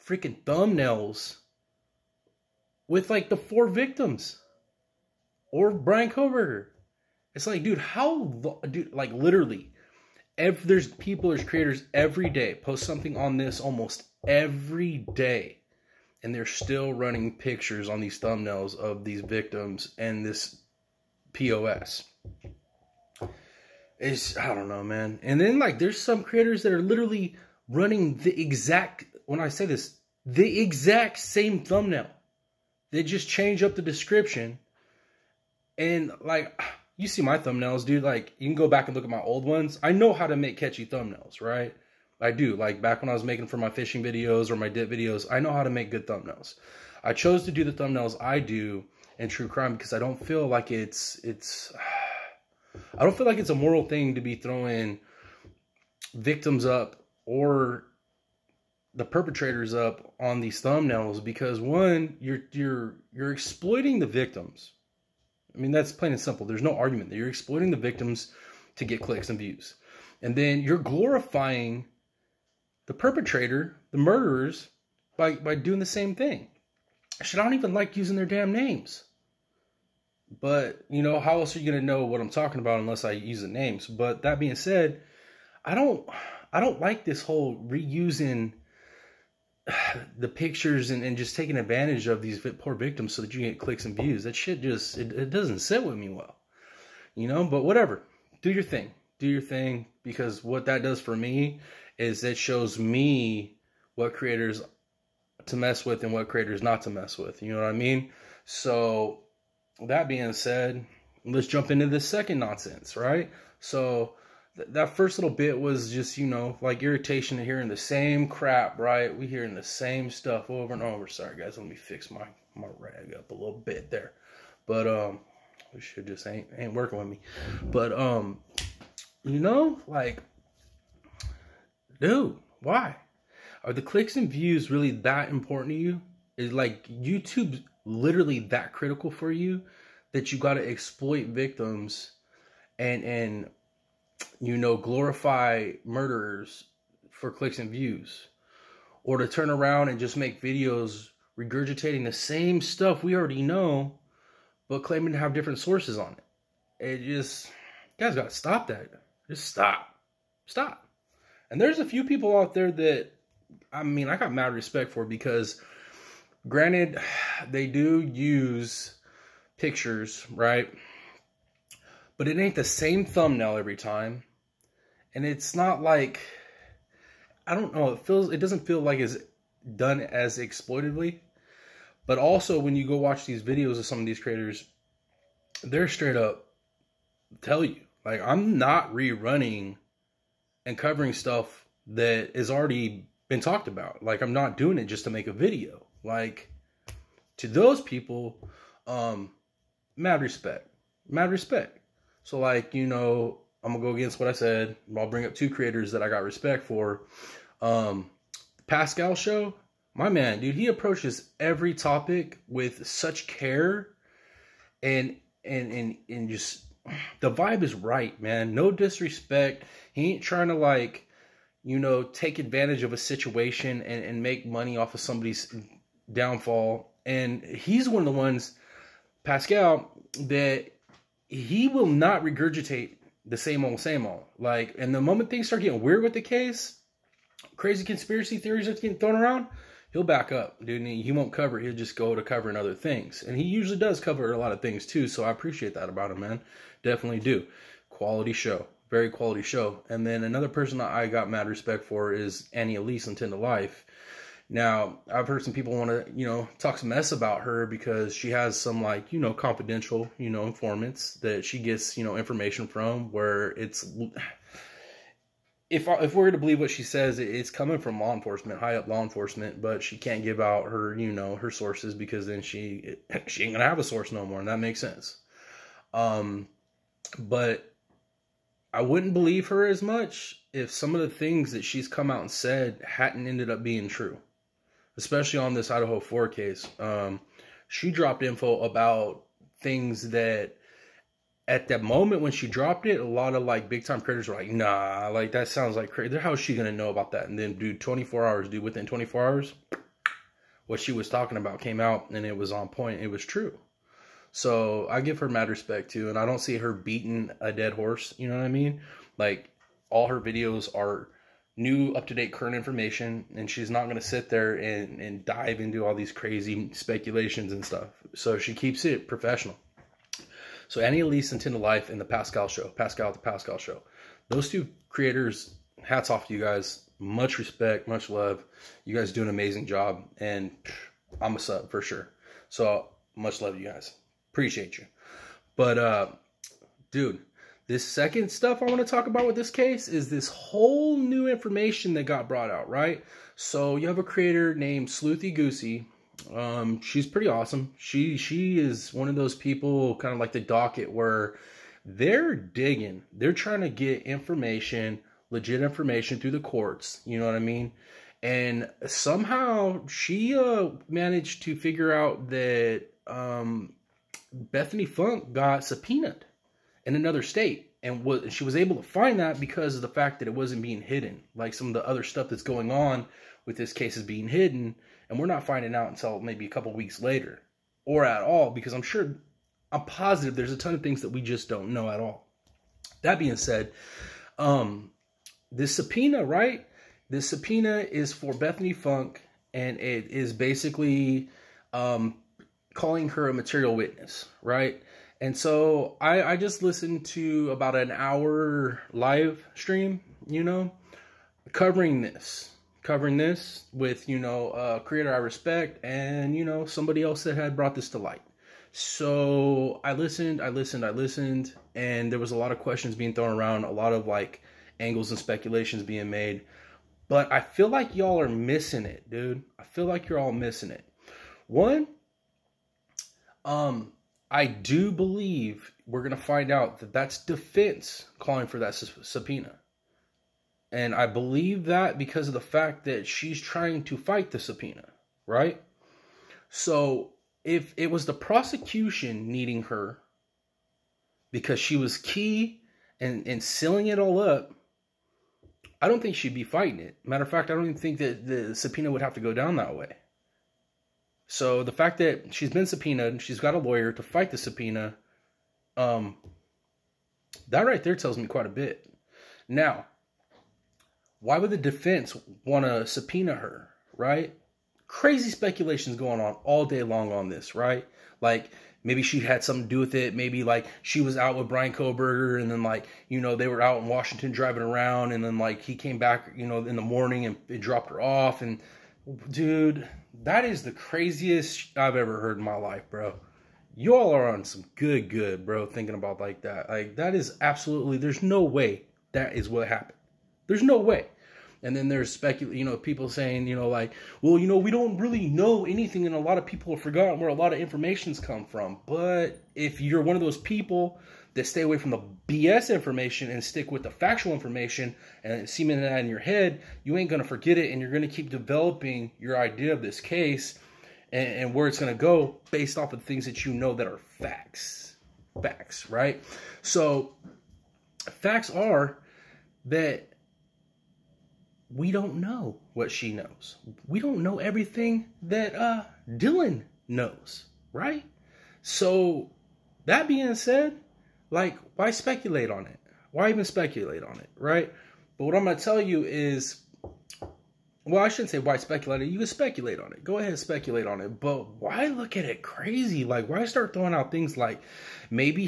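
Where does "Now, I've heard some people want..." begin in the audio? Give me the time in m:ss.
4:14.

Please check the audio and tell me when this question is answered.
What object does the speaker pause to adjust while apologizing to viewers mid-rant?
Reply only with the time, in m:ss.
2:02.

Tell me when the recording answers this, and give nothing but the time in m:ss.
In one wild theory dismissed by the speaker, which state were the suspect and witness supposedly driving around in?
7:53.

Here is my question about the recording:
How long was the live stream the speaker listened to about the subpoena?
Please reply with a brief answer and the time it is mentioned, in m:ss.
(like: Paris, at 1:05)
about an hour, at 6:37.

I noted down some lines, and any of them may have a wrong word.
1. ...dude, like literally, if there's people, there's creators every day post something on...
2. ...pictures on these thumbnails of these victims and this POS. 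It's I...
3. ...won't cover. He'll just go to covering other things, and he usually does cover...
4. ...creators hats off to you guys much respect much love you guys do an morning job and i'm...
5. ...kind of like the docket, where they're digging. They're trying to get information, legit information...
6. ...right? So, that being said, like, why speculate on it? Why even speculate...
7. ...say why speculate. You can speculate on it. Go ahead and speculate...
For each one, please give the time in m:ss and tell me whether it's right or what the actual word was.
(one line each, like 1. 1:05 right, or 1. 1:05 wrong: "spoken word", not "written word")
1. 0:08 right
2. 0:17 right
3. 4:01 right
4. 5:24 wrong: "amazing", not "morning"
5. 5:49 right
6. 8:47 right
7. 8:58 right.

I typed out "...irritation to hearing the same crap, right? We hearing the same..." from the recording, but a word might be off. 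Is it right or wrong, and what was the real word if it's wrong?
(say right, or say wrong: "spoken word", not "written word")
right.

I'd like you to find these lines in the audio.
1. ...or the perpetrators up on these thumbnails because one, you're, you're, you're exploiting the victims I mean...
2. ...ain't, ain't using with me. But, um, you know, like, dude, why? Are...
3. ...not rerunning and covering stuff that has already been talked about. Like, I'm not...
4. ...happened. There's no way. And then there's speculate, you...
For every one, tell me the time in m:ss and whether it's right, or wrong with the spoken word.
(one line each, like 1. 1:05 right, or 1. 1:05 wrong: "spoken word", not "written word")
1. 0:57 right
2. 2:06 wrong: "working", not "using"
3. 3:08 right
4. 8:09 right.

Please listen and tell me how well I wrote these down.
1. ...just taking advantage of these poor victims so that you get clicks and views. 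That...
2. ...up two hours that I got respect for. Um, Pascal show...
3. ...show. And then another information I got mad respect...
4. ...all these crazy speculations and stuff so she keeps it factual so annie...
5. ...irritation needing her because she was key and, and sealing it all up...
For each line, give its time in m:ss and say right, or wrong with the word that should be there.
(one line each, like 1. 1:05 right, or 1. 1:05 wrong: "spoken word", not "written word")
1. 1:31 right
2. 3:25 wrong: "creators", not "hours"
3. 4:09 wrong: "person", not "information"
4. 5:15 wrong: "professional", not "factual"
5. 7:18 wrong: "prosecution", not "irritation".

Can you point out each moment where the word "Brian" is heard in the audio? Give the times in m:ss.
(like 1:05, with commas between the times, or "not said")
0:05, 7:51.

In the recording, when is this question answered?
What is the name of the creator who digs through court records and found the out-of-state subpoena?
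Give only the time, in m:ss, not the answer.
5:44.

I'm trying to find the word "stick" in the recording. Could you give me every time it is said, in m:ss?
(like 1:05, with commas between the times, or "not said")
8:23.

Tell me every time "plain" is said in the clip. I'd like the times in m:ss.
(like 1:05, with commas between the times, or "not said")
1:05.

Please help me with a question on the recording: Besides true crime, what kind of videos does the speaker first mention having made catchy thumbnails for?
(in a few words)
fishing videos.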